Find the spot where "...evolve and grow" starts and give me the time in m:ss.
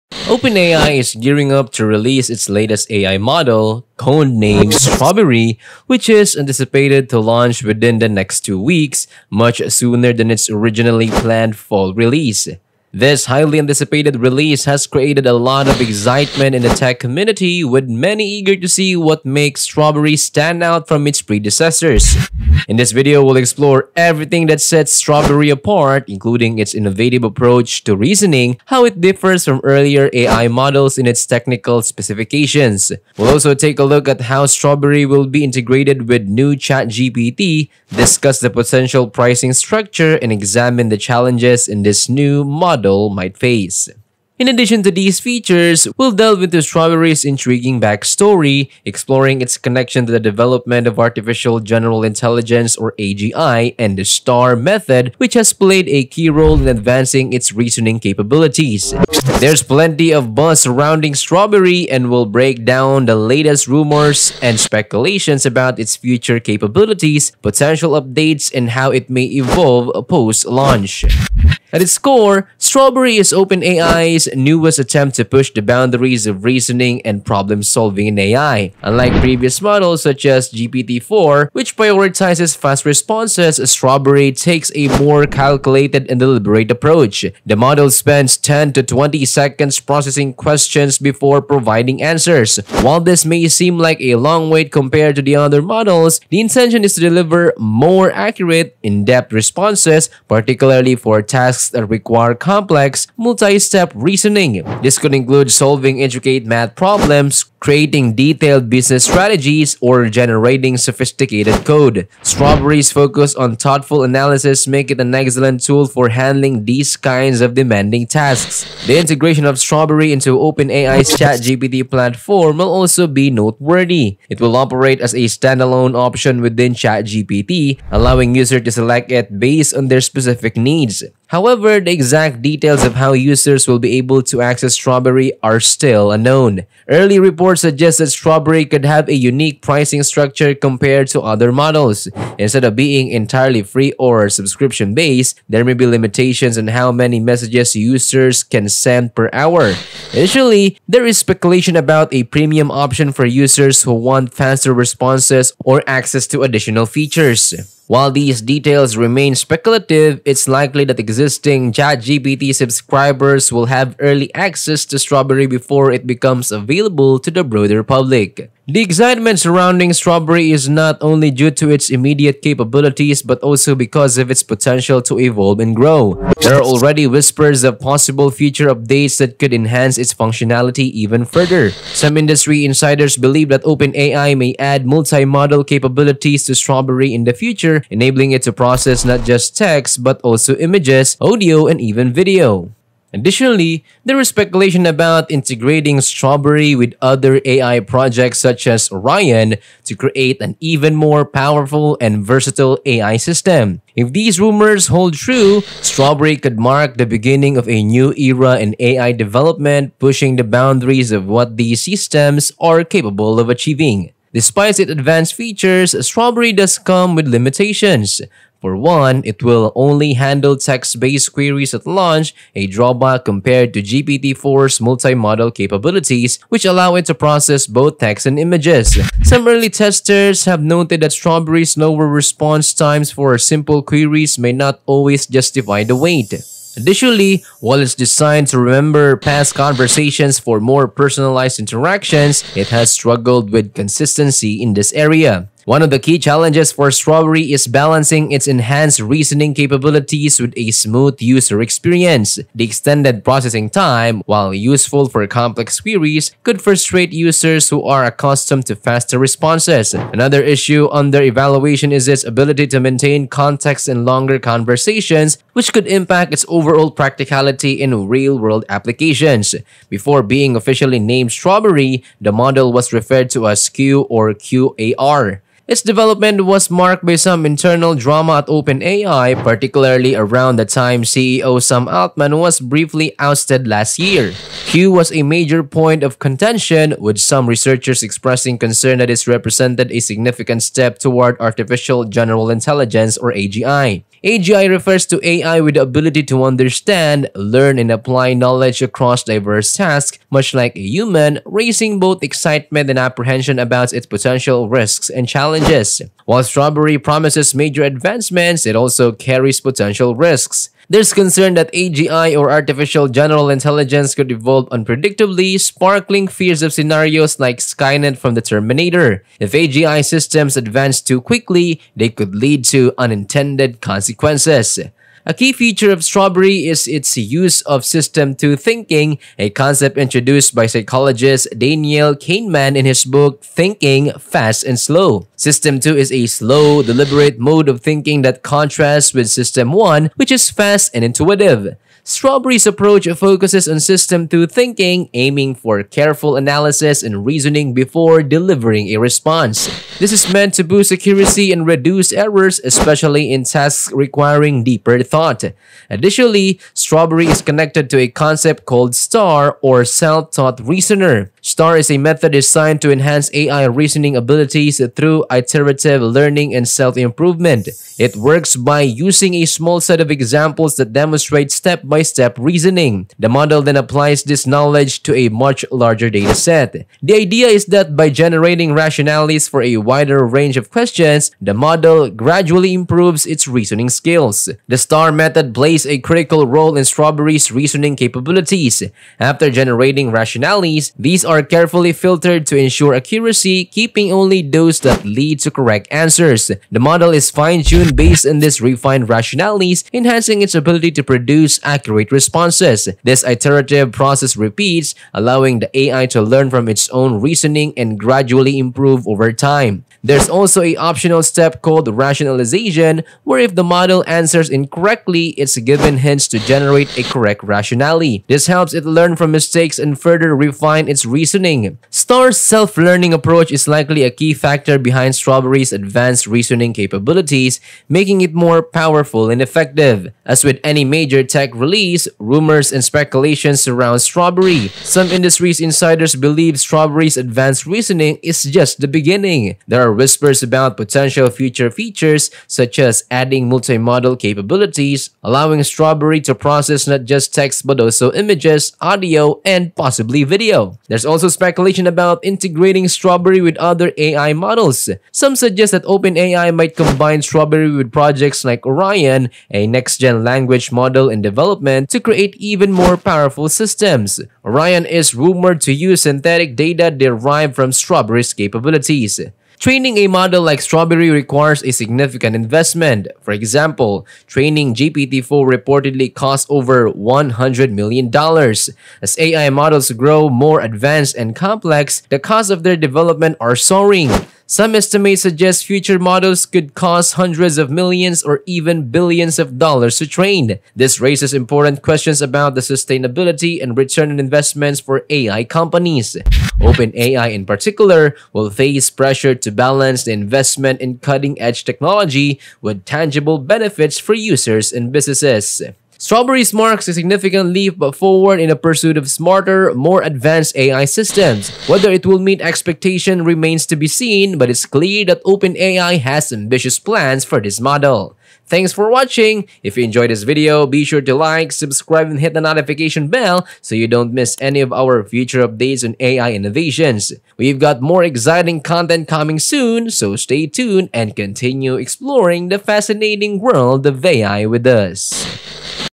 2:55.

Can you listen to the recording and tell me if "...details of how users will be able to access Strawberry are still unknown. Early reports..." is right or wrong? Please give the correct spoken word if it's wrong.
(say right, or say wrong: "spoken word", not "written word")
right.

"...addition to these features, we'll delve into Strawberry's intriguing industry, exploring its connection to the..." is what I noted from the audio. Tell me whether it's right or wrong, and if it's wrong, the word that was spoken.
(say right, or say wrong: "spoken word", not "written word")
wrong: "backstory", not "industry".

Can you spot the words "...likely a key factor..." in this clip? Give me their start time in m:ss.
7:03.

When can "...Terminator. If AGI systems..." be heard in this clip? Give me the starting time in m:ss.
5:18.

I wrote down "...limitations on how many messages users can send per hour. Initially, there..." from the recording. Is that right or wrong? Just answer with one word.
right.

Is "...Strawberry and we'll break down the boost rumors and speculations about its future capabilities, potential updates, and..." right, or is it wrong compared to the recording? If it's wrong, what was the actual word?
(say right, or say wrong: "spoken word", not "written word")
wrong: "latest", not "boost".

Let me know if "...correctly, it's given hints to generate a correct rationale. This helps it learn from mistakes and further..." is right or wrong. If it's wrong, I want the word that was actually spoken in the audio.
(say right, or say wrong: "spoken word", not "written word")
right.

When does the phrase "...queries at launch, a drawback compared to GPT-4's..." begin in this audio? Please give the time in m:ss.
3:41.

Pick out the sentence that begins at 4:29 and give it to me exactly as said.
Before being officially named Strawberry, the model was referred to as Q or Q-Star.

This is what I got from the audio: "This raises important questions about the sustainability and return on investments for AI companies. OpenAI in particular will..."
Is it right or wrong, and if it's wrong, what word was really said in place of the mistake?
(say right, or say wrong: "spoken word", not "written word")
right.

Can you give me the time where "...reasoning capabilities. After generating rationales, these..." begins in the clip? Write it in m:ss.
6:27.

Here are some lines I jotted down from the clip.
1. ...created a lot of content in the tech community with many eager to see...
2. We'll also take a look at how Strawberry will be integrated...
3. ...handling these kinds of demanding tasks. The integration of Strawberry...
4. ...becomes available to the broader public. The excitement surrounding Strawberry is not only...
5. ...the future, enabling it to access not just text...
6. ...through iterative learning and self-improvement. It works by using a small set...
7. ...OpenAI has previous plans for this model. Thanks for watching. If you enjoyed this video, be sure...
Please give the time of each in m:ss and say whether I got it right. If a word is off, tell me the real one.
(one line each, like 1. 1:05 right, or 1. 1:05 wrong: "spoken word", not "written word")
1. 0:14 wrong: "excitement", not "content"
2. 0:33 right
3. 1:56 right
4. 2:46 right
5. 3:07 wrong: "process", not "access"
6. 6:04 right
7. 8:35 wrong: "ambitious", not "previous".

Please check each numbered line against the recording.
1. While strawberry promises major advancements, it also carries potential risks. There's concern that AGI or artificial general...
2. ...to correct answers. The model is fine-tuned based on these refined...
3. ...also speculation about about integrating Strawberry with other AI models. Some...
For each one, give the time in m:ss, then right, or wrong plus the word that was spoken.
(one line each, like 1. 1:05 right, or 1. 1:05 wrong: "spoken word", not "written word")
1. 5:06 right
2. 6:35 right
3. 7:31 right.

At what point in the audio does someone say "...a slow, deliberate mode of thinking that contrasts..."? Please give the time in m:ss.
5:36.